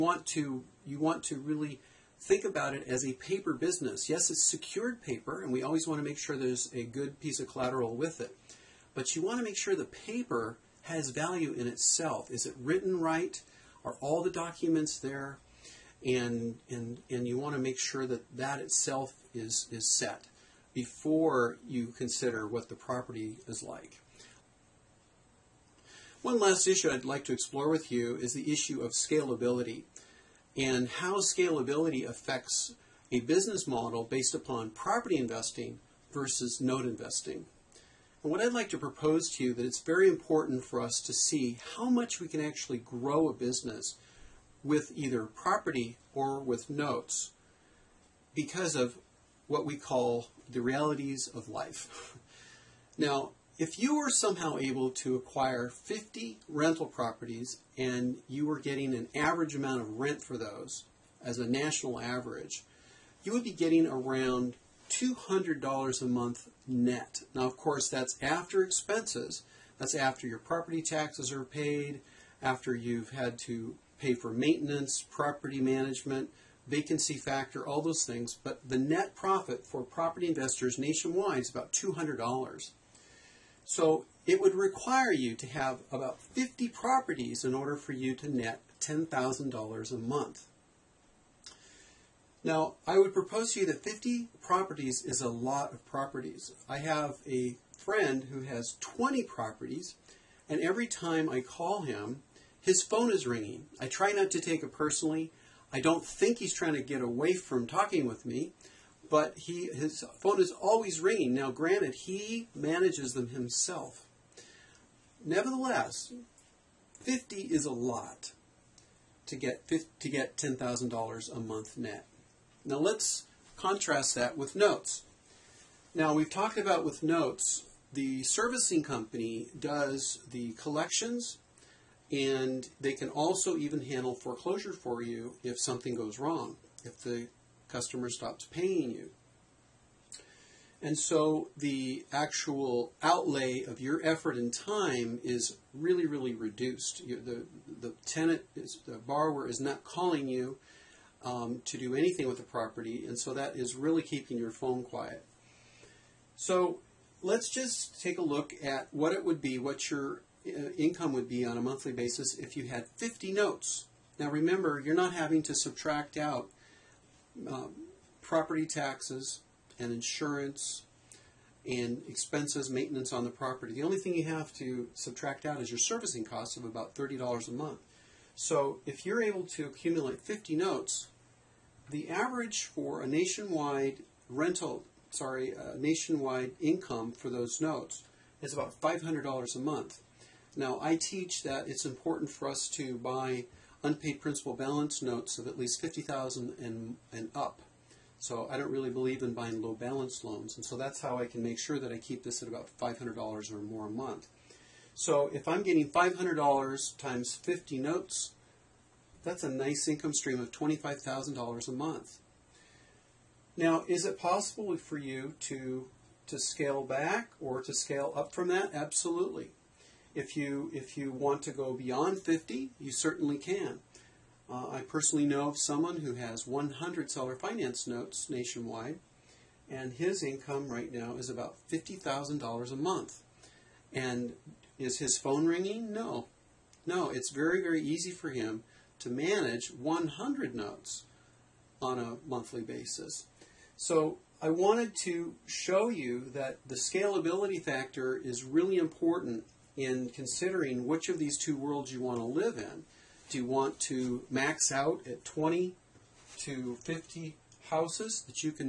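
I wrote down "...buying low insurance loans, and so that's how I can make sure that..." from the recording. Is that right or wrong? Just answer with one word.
wrong.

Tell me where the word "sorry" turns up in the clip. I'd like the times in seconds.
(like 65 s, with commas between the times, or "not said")
185 s.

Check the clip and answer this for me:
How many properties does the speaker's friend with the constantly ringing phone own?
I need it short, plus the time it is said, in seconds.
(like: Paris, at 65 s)
20, at 98 s.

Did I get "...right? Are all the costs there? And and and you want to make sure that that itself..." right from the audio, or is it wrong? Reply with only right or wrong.
wrong.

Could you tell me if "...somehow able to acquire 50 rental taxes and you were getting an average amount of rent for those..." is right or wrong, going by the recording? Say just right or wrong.
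wrong.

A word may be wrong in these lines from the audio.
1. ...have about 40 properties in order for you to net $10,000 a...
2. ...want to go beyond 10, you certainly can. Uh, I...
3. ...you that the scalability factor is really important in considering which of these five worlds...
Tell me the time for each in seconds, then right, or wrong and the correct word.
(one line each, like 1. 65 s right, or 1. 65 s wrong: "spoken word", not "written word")
1. 85 s wrong: "50", not "40"
2. 221 s wrong: "50", not "10"
3. 245 s wrong: "two", not "five".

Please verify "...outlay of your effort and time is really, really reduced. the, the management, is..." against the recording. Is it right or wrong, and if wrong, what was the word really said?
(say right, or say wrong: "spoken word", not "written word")
wrong: "tenant", not "management".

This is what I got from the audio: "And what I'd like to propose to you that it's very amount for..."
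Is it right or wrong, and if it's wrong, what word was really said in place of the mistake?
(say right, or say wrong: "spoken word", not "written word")
wrong: "important", not "amount".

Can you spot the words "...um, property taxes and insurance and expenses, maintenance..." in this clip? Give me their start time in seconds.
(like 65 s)
167 s.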